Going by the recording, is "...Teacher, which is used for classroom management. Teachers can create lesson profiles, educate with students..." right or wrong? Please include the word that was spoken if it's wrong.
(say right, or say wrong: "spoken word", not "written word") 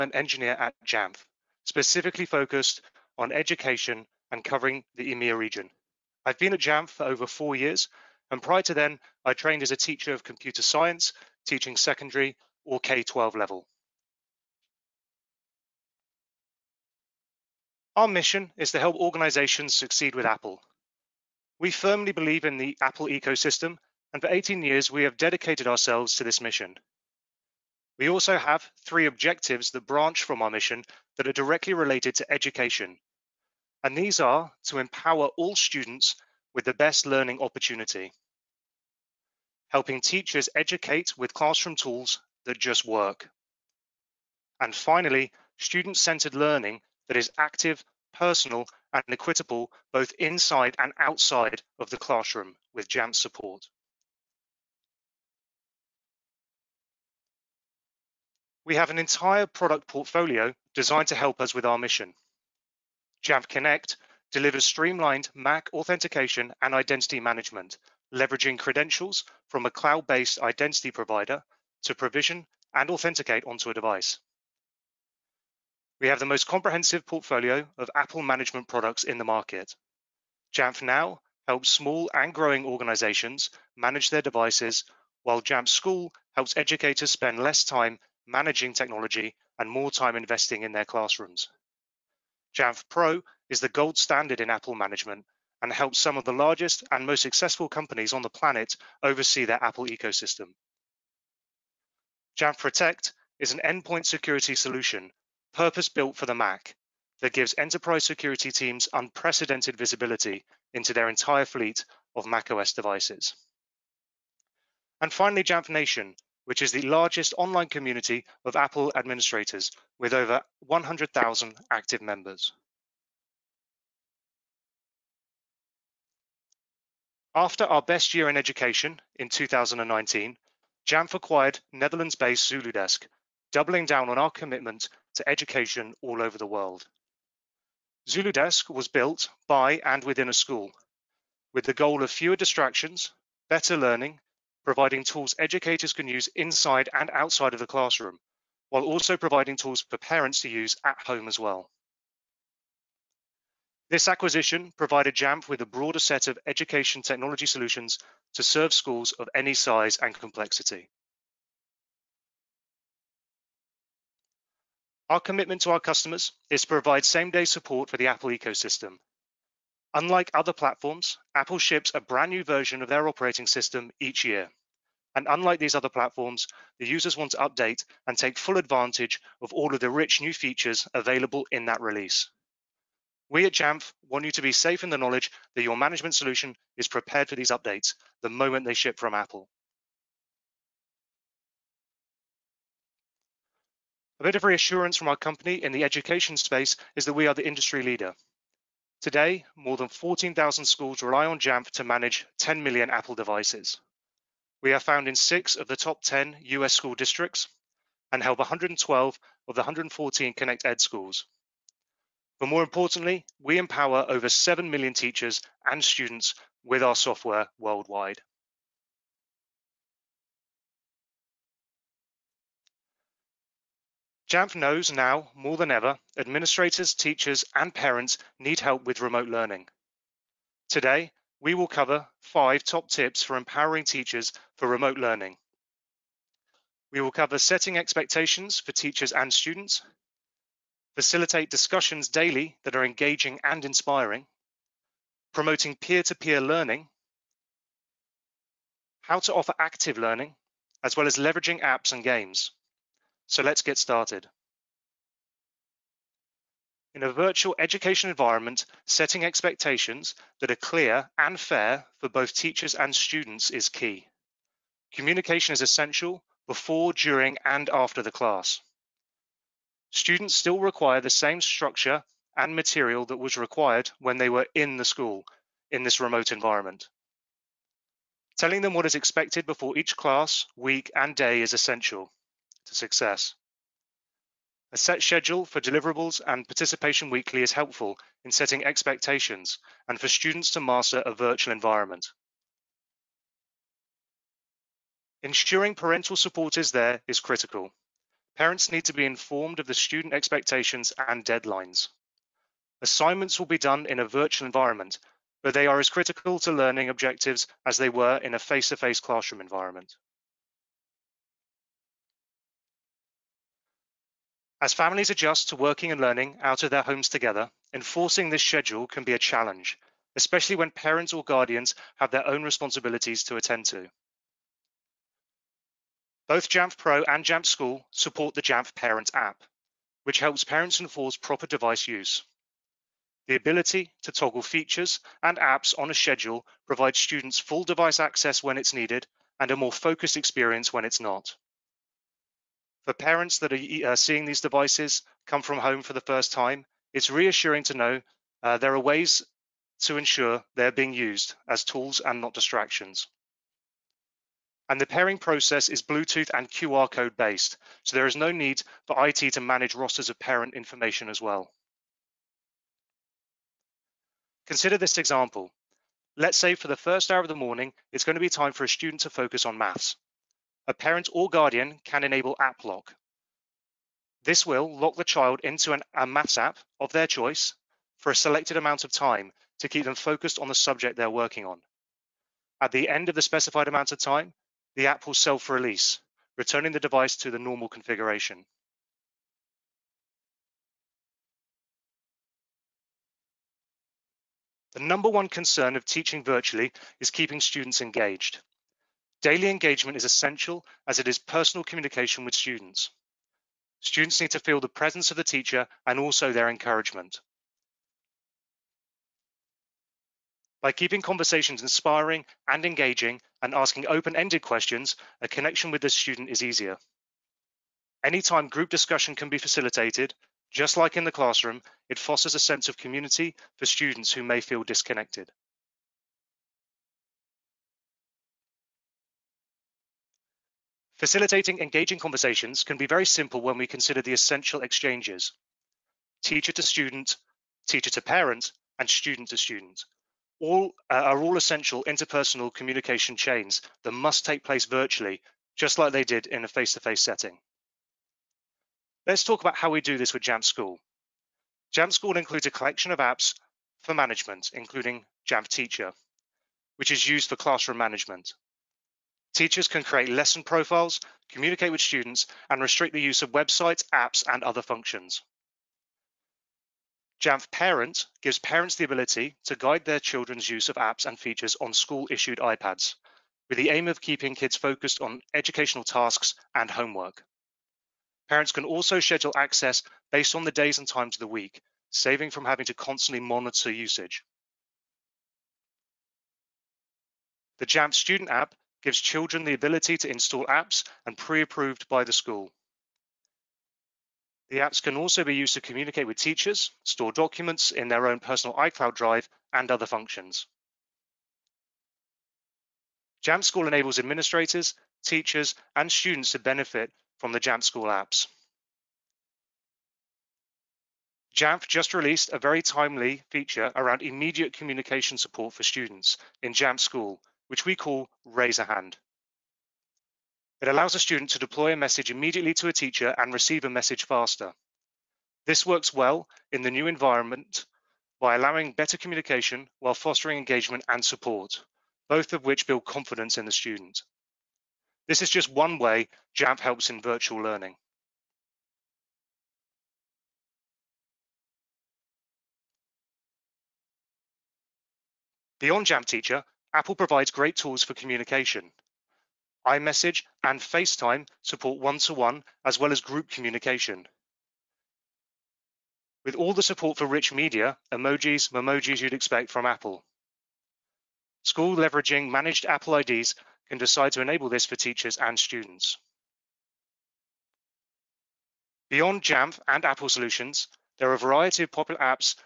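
wrong: "communicate", not "educate".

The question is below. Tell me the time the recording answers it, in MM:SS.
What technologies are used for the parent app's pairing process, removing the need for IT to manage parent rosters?
05:55.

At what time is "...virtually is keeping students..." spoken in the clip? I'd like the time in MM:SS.
06:36.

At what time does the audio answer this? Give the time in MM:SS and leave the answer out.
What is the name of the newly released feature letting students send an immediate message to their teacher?
08:38.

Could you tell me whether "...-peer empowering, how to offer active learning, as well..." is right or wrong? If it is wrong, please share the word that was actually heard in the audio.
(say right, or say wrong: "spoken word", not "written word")
wrong: "learning", not "empowering".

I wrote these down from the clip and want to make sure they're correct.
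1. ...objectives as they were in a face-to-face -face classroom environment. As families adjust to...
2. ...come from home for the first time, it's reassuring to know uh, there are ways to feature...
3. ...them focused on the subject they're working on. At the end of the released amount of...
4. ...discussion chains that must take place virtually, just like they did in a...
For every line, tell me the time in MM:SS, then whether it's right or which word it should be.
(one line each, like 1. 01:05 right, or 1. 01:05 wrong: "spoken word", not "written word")
1. 05:06 right
2. 05:45 wrong: "ensure", not "feature"
3. 06:19 wrong: "specified", not "released"
4. 07:22 wrong: "communication", not "discussion".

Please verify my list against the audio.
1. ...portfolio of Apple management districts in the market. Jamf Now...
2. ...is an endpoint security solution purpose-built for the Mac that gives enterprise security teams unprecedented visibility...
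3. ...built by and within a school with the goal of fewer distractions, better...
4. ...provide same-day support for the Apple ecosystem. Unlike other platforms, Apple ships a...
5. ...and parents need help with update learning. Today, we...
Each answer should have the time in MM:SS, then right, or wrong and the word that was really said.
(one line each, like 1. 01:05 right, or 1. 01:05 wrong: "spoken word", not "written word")
1. 01:17 wrong: "products", not "districts"
2. 01:43 right
3. 02:18 right
4. 02:46 right
5. 03:47 wrong: "remote", not "update".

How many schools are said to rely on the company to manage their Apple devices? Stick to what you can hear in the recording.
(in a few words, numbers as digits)
14,000.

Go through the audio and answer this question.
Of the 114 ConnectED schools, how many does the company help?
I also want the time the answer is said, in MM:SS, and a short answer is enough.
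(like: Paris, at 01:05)
112, at 03:28.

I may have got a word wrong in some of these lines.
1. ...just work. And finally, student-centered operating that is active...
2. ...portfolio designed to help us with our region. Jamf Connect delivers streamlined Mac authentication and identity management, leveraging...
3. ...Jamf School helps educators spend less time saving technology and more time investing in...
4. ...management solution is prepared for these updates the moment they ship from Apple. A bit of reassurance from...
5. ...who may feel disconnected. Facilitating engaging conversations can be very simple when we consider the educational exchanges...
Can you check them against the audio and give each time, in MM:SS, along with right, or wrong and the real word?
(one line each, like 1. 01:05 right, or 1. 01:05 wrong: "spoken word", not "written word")
1. 00:42 wrong: "learning", not "operating"
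2. 00:59 wrong: "mission", not "region"
3. 01:25 wrong: "managing", not "saving"
4. 03:05 right
5. 07:04 wrong: "essential", not "educational".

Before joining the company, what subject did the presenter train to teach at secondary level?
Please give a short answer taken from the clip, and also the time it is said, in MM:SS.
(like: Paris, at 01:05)
Computer science, at 00:10.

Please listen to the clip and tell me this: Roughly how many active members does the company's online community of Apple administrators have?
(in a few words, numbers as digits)
100,000.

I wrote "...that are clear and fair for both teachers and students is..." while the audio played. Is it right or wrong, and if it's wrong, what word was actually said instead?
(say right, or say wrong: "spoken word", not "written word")
right.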